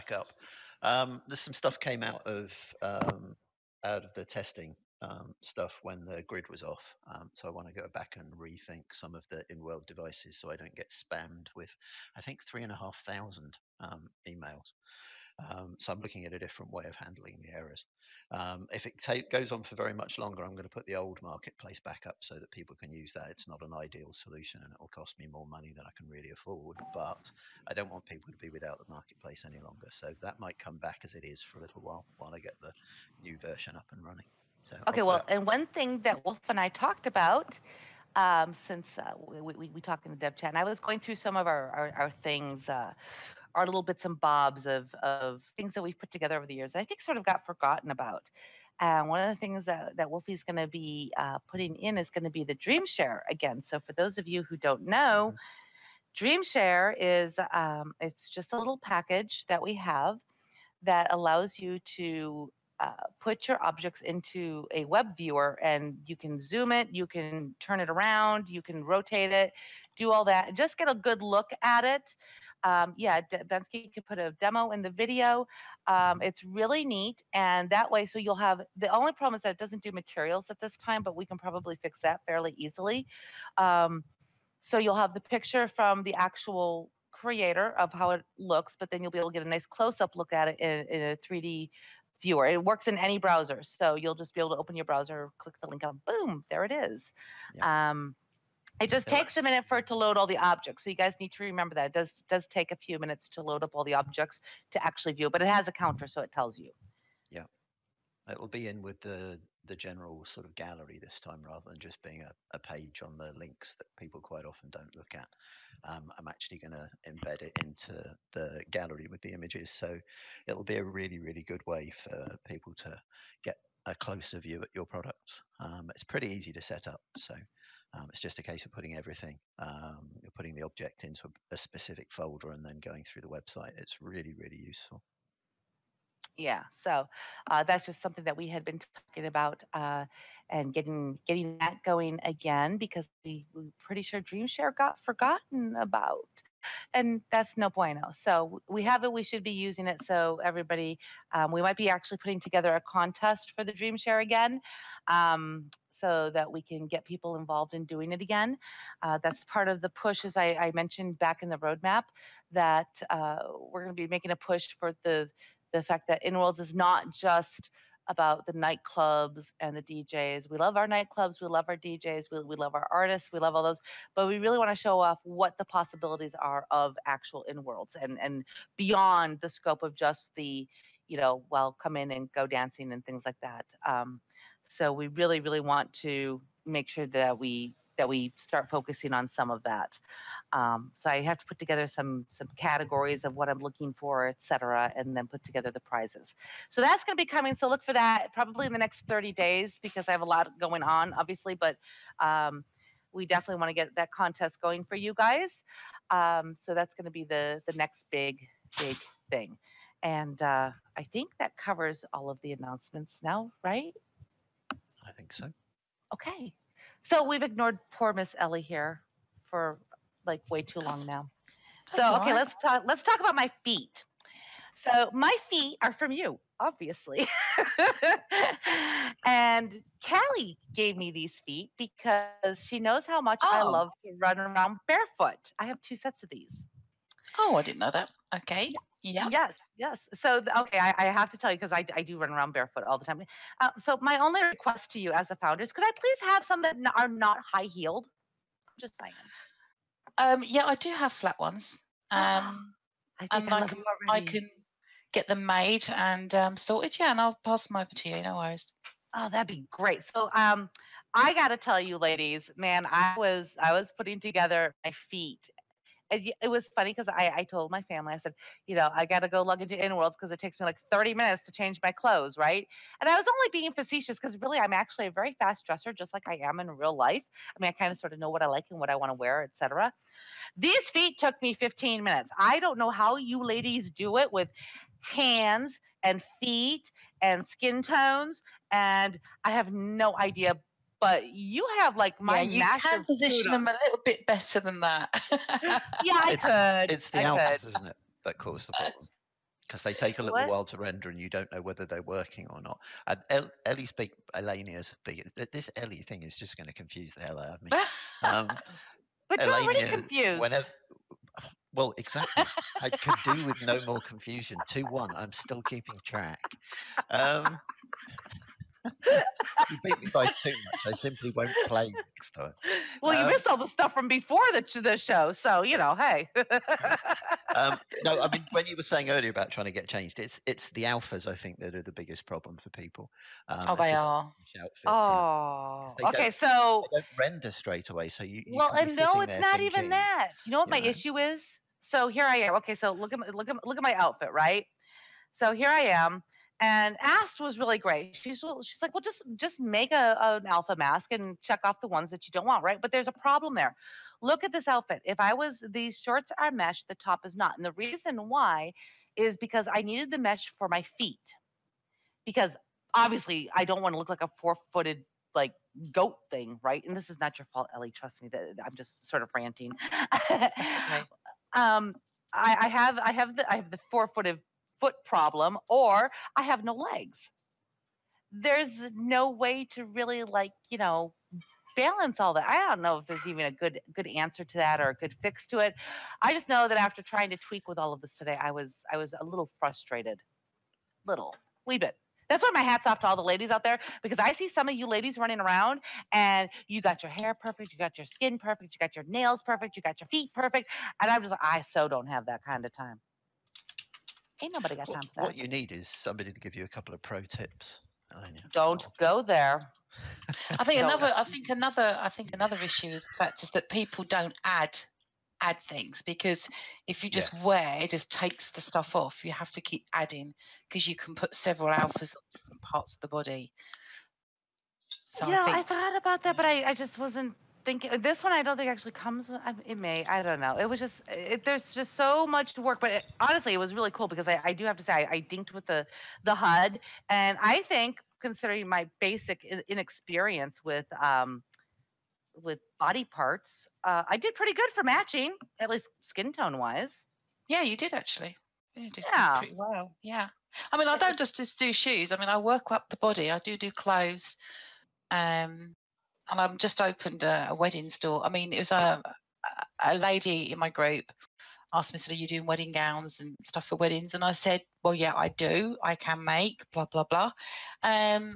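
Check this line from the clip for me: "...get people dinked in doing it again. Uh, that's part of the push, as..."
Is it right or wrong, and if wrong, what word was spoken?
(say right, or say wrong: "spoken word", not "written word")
wrong: "involved", not "dinked".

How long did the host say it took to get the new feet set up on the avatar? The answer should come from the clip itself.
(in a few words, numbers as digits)
15 minutes.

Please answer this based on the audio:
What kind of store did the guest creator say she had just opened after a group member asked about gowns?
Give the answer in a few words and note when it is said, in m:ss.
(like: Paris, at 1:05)
wedding store, at 7:37.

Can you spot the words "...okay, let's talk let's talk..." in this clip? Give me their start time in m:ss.
3:42.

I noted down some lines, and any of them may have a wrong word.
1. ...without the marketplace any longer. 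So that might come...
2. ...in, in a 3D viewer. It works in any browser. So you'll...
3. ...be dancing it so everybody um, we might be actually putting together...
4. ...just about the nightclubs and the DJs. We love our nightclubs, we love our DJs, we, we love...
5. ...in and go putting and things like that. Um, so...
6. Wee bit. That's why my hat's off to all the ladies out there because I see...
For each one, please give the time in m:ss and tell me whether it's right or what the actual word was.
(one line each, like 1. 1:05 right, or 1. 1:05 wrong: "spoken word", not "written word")
1. 0:28 right
2. 1:30 right
3. 2:29 wrong: "using", not "dancing"
4. 2:47 right
5. 3:01 wrong: "dancing", not "putting"
6. 6:31 right.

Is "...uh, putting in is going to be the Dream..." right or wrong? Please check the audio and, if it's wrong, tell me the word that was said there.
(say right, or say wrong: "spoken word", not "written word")
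right.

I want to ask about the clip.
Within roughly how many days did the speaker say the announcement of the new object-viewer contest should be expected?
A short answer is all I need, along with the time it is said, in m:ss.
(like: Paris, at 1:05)
30 days, at 3:19.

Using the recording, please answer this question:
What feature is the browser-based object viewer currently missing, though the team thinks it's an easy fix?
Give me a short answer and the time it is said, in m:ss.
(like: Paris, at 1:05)
materials, at 1:19.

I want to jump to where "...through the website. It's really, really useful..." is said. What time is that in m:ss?
2:13.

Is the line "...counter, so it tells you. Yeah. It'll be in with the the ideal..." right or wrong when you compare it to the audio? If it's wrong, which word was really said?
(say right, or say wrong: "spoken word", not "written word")
wrong: "general", not "ideal".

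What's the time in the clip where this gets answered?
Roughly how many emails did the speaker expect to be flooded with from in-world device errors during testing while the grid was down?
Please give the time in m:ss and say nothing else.
0:12.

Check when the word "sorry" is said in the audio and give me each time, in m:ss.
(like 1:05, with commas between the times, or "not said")
not said.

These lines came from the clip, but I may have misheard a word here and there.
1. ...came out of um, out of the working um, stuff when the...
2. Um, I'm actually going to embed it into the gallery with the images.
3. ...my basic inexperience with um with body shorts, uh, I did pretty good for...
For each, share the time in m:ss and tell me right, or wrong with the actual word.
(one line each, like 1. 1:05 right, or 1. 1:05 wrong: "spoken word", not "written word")
1. 0:01 wrong: "testing", not "working"
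2. 1:55 right
3. 7:18 wrong: "parts", not "shorts".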